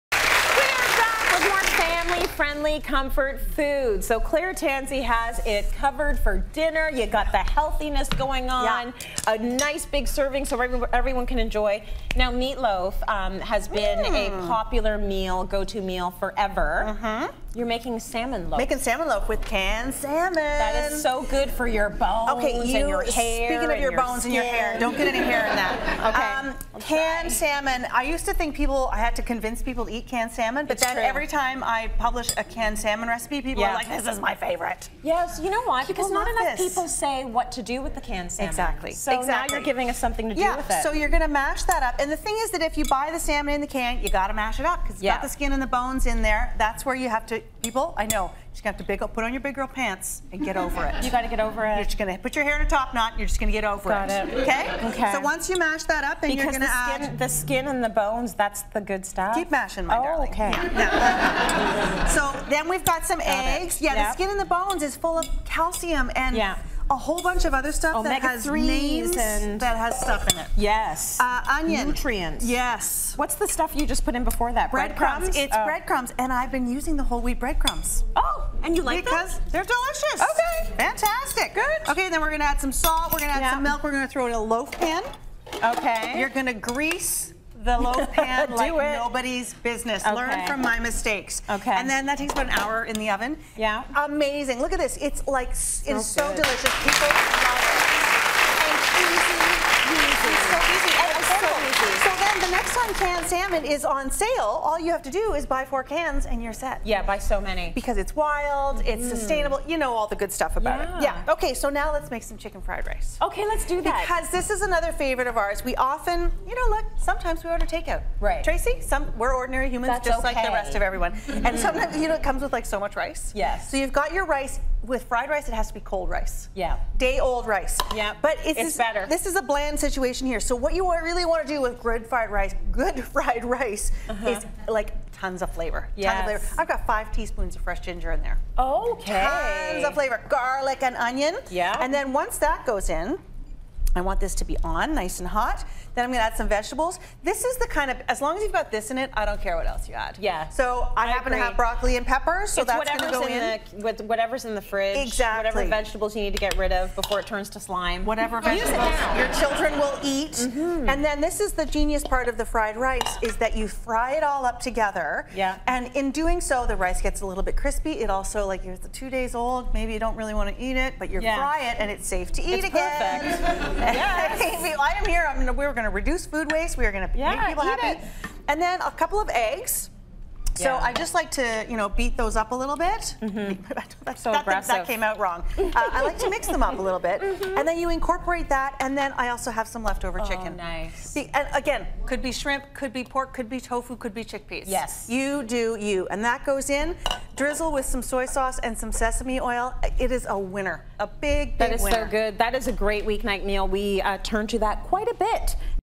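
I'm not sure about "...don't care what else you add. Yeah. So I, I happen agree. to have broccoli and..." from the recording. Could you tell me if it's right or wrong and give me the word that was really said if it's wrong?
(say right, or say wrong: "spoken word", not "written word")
right.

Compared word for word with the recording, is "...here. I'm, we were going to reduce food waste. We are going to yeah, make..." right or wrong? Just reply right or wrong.
right.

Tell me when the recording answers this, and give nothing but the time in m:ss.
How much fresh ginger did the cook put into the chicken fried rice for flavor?
2:16.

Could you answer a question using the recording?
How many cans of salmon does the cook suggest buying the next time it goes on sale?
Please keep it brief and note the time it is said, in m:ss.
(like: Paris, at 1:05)
4, at 1:45.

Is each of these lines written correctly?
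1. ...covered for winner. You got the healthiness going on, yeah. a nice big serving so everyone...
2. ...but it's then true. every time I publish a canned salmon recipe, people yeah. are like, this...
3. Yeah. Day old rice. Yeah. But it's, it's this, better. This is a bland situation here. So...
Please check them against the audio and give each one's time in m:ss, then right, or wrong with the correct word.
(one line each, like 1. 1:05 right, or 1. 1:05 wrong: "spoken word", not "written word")
1. 0:05 wrong: "dinner", not "winner"
2. 0:30 right
3. 2:06 right.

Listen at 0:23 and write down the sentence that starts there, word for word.
Speaking of your, your bones skin.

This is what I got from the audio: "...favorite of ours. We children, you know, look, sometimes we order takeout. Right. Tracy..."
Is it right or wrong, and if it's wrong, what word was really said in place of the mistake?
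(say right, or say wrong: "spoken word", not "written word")
wrong: "often", not "children".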